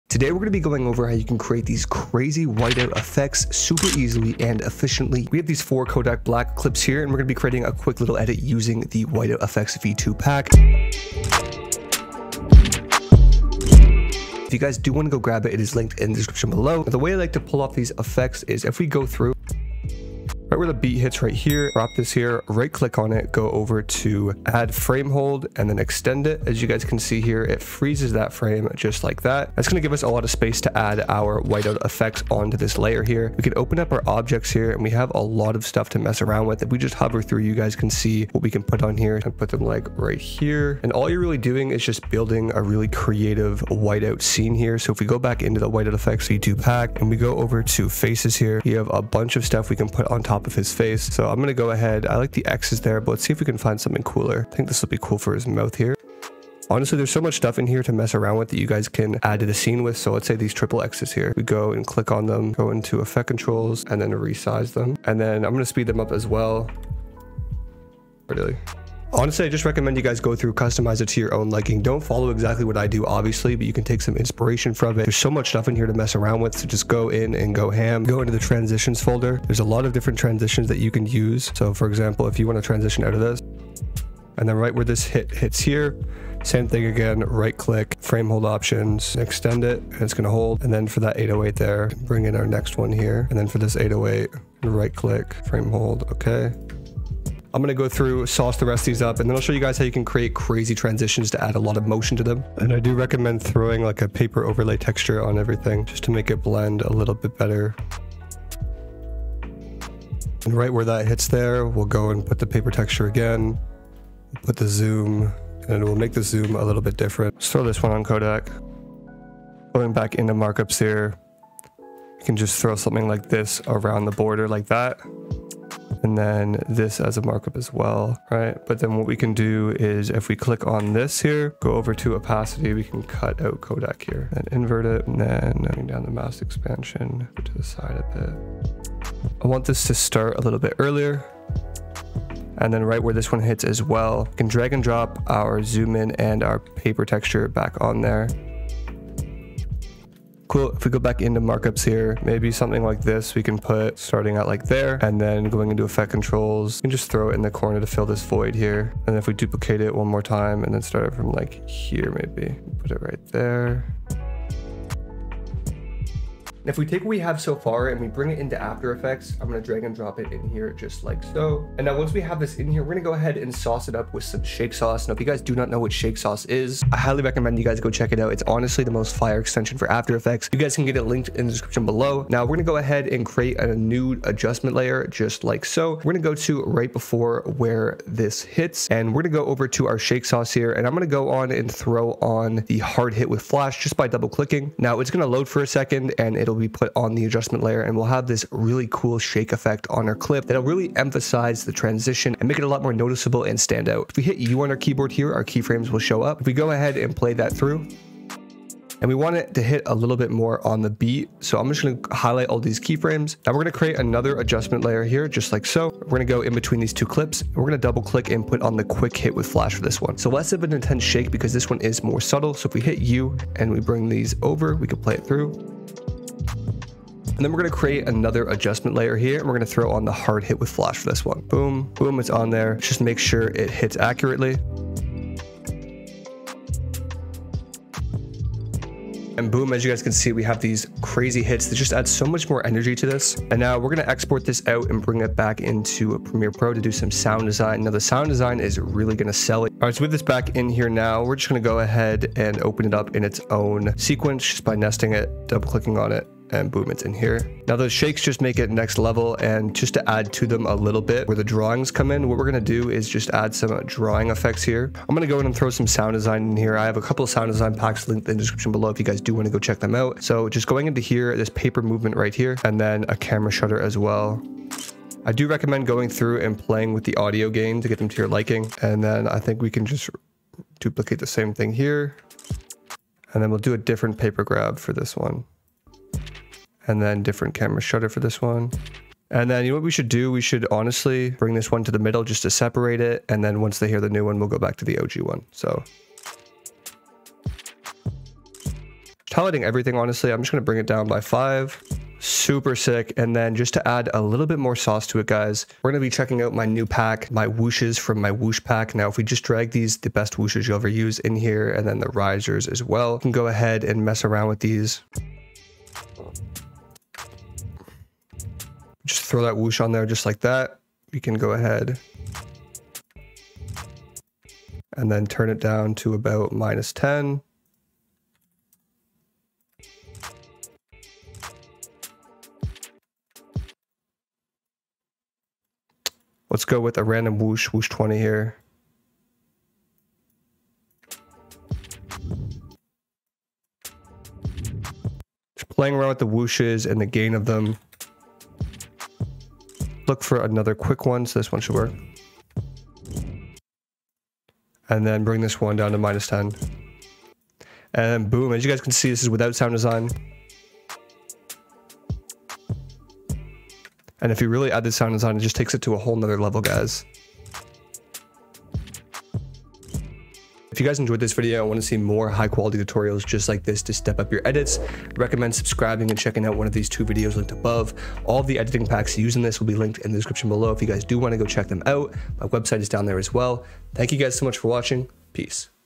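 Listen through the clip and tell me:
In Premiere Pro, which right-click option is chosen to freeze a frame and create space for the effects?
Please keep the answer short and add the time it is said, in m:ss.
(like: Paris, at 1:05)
Add frame hold, at 0:24.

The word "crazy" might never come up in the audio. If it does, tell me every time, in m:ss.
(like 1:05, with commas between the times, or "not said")
0:01, 1:40, 4:01.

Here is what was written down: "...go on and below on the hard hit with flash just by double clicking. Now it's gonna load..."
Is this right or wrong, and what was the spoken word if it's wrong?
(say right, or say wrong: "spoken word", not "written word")
wrong: "throw", not "below".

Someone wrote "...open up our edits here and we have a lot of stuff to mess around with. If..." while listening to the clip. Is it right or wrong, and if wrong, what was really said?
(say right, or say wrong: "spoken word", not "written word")
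wrong: "objects", not "edits".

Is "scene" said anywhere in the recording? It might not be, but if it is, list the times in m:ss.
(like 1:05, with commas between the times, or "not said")
0:44, 0:59.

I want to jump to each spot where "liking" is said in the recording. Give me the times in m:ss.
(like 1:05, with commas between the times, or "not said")
1:11, 4:38.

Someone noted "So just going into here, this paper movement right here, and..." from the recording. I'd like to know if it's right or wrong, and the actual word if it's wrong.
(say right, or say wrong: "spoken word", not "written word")
right.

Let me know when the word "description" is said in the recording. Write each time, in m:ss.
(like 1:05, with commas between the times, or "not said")
0:16, 3:01, 4:28, 6:20.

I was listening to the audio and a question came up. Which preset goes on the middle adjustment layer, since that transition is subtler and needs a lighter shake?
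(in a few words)
Quick hit with flash.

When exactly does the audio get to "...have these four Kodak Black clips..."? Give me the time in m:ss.
0:05.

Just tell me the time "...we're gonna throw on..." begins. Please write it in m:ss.
3:49.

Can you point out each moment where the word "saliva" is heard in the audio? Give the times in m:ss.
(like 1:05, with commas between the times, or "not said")
not said.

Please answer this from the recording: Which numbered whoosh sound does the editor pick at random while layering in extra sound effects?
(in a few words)
Whoosh 20.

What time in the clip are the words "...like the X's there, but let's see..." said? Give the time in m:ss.
0:52.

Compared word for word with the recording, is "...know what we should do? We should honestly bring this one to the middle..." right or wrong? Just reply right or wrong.
right.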